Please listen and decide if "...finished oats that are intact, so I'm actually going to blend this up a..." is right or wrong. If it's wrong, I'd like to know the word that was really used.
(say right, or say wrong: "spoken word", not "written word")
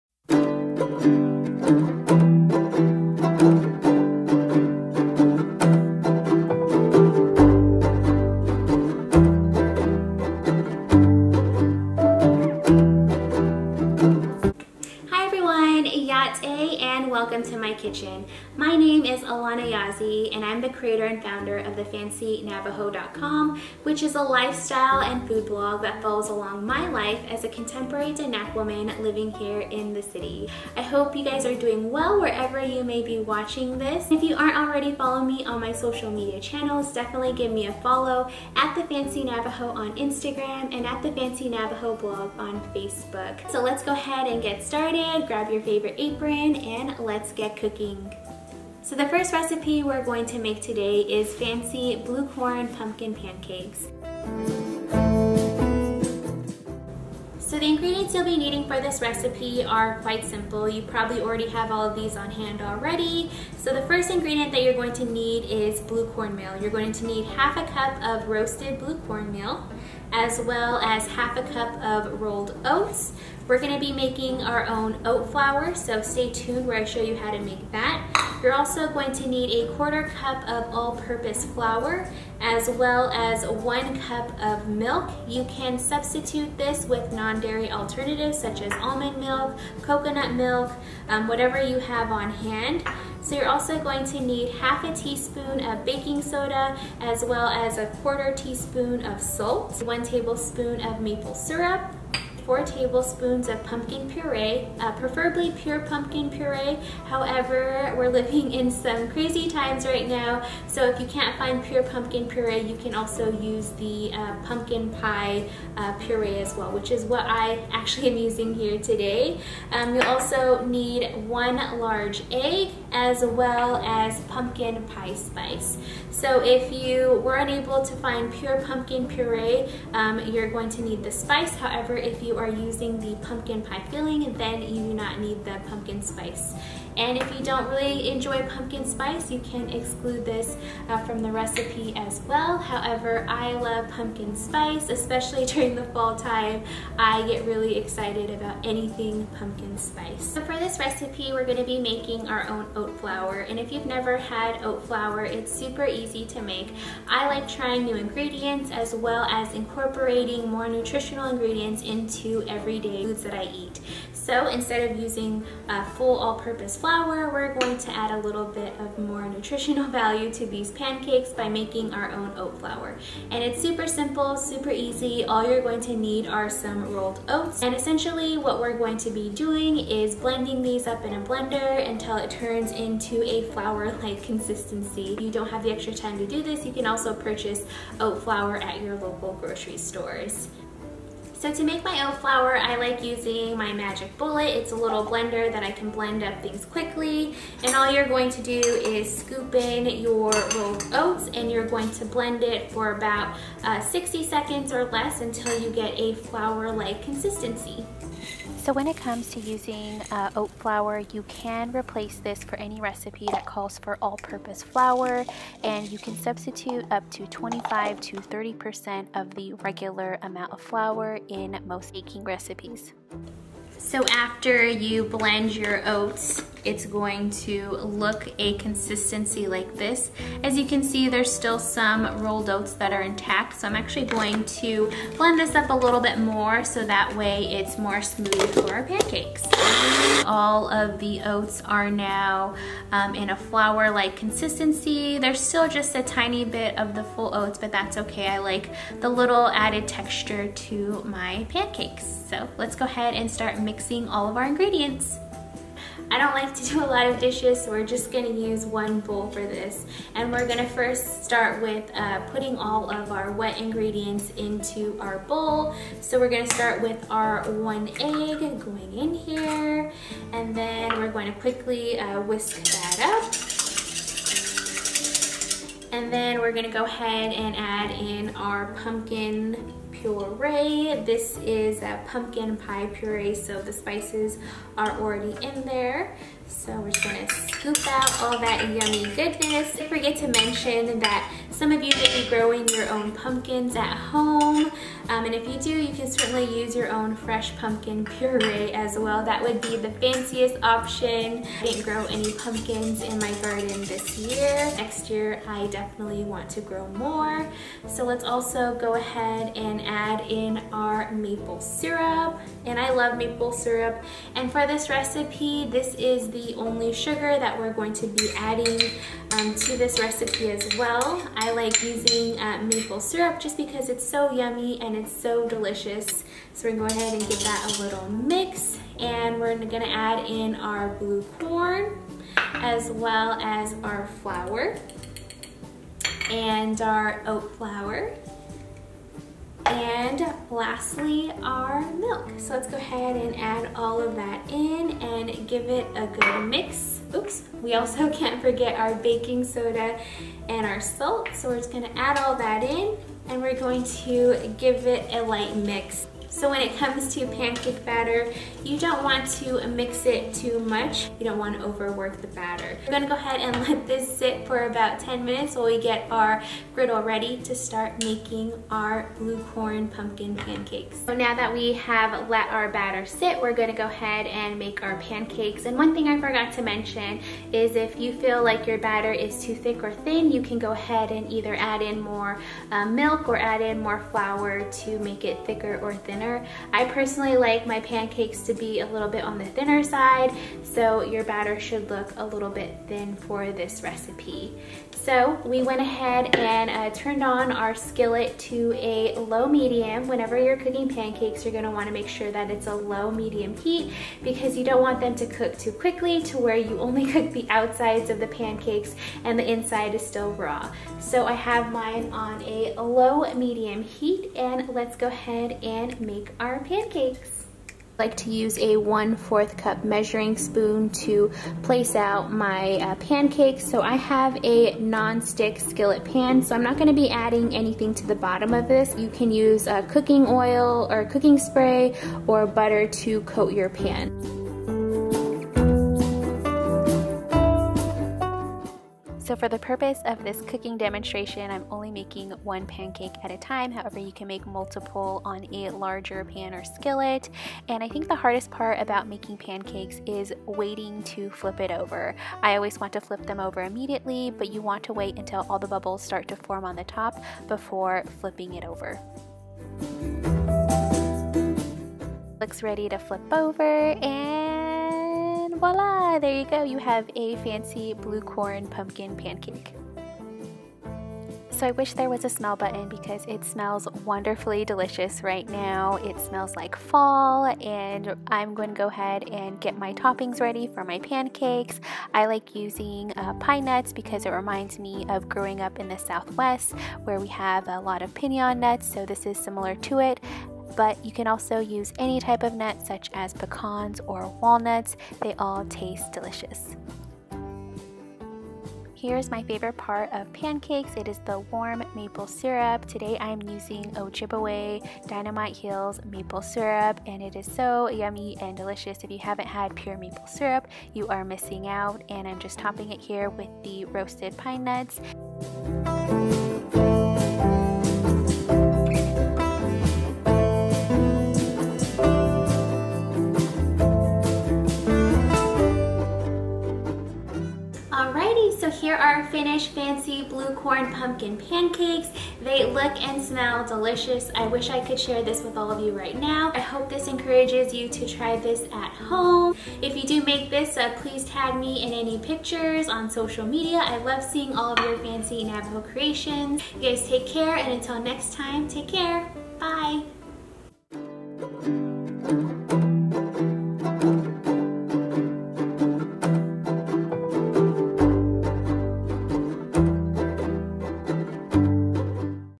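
wrong: "rolled", not "finished".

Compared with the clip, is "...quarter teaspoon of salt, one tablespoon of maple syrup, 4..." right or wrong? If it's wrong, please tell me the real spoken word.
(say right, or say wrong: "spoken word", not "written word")
right.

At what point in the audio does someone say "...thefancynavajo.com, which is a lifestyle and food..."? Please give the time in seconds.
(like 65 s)
21 s.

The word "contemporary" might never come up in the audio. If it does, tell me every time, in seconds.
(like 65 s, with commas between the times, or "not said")
27 s.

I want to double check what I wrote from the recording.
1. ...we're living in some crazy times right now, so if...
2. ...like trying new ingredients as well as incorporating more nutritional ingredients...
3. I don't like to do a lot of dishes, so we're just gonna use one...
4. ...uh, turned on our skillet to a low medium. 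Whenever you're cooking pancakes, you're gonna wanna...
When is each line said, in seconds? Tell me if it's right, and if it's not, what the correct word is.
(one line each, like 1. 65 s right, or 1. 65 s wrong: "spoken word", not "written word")
1. 107 s right
2. 157 s right
3. 256 s right
4. 396 s right.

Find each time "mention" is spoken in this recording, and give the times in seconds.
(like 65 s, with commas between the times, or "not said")
290 s, 376 s.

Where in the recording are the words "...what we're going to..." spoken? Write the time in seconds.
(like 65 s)
178 s.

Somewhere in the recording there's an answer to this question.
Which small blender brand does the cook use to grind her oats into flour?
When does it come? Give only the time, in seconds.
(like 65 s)
193 s.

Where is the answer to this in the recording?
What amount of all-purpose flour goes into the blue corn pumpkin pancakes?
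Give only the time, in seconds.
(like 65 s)
79 s.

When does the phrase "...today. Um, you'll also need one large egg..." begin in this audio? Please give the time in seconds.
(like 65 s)
118 s.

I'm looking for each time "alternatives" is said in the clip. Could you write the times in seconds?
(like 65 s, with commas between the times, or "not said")
87 s.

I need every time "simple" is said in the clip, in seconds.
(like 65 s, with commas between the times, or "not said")
60 s, 173 s.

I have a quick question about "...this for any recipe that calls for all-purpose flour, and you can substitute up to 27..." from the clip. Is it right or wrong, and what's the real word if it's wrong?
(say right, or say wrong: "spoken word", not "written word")
wrong: "25", not "27".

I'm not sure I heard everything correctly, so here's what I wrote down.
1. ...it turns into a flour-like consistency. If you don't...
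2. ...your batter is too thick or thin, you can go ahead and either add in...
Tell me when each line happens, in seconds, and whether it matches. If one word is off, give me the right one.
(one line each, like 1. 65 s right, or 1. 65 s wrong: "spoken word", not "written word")
1. 182 s right
2. 378 s right.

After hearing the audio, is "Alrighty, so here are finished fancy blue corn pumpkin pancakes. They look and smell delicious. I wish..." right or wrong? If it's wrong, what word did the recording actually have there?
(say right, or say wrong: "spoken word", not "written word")
right.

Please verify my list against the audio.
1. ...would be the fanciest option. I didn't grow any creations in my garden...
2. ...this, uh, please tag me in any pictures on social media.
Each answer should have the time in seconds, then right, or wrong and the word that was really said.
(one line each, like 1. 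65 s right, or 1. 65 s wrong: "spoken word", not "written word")
1. 299 s wrong: "pumpkins", not "creations"
2. 540 s right.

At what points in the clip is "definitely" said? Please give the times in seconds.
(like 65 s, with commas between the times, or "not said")
36 s, 305 s.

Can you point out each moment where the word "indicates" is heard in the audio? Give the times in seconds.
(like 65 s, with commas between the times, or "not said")
not said.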